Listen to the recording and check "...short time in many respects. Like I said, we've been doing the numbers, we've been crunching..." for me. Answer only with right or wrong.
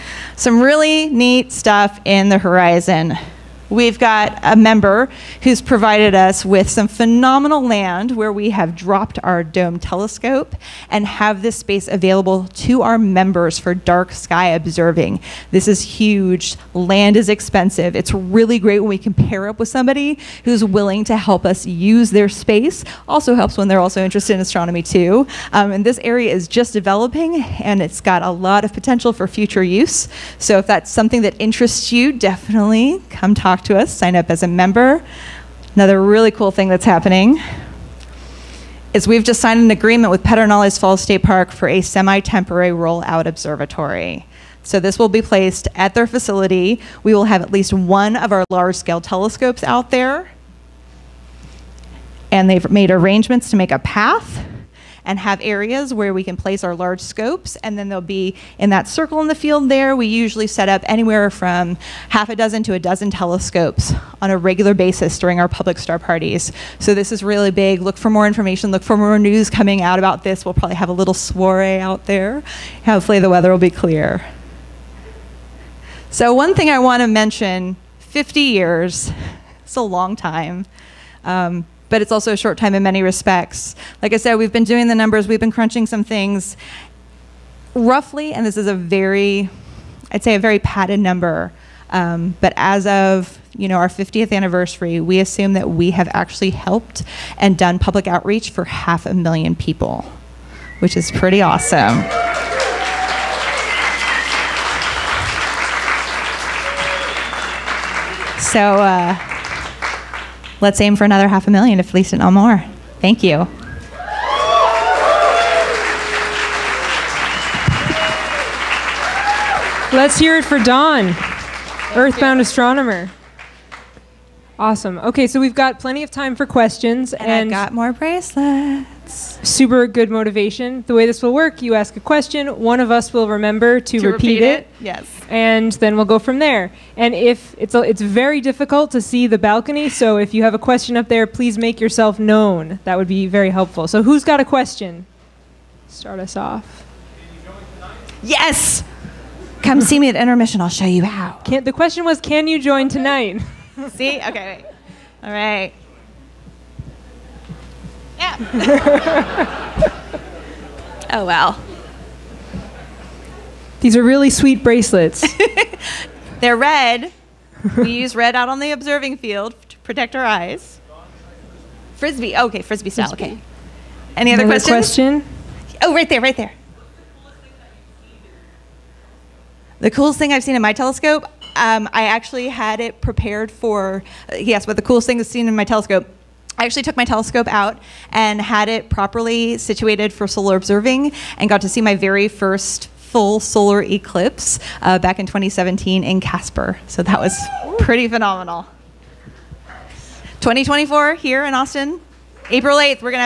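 right.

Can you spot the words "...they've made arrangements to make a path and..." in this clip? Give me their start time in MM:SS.
00:52.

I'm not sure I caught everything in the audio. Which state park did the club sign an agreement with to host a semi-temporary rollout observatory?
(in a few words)
Pedernales Falls State Park.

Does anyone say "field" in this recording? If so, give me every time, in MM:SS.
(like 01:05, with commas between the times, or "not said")
00:59, 02:49.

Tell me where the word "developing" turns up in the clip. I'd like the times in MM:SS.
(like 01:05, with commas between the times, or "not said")
00:26.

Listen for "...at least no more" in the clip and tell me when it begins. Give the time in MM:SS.
01:51.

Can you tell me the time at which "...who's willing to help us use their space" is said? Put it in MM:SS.
00:20.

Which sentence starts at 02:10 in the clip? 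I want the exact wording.
The way this will work, you ask a question, one of us will remember to, to repeat, repeat it, it.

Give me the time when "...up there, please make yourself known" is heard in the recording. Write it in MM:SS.
02:20.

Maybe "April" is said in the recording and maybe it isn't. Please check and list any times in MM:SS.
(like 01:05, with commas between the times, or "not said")
03:22.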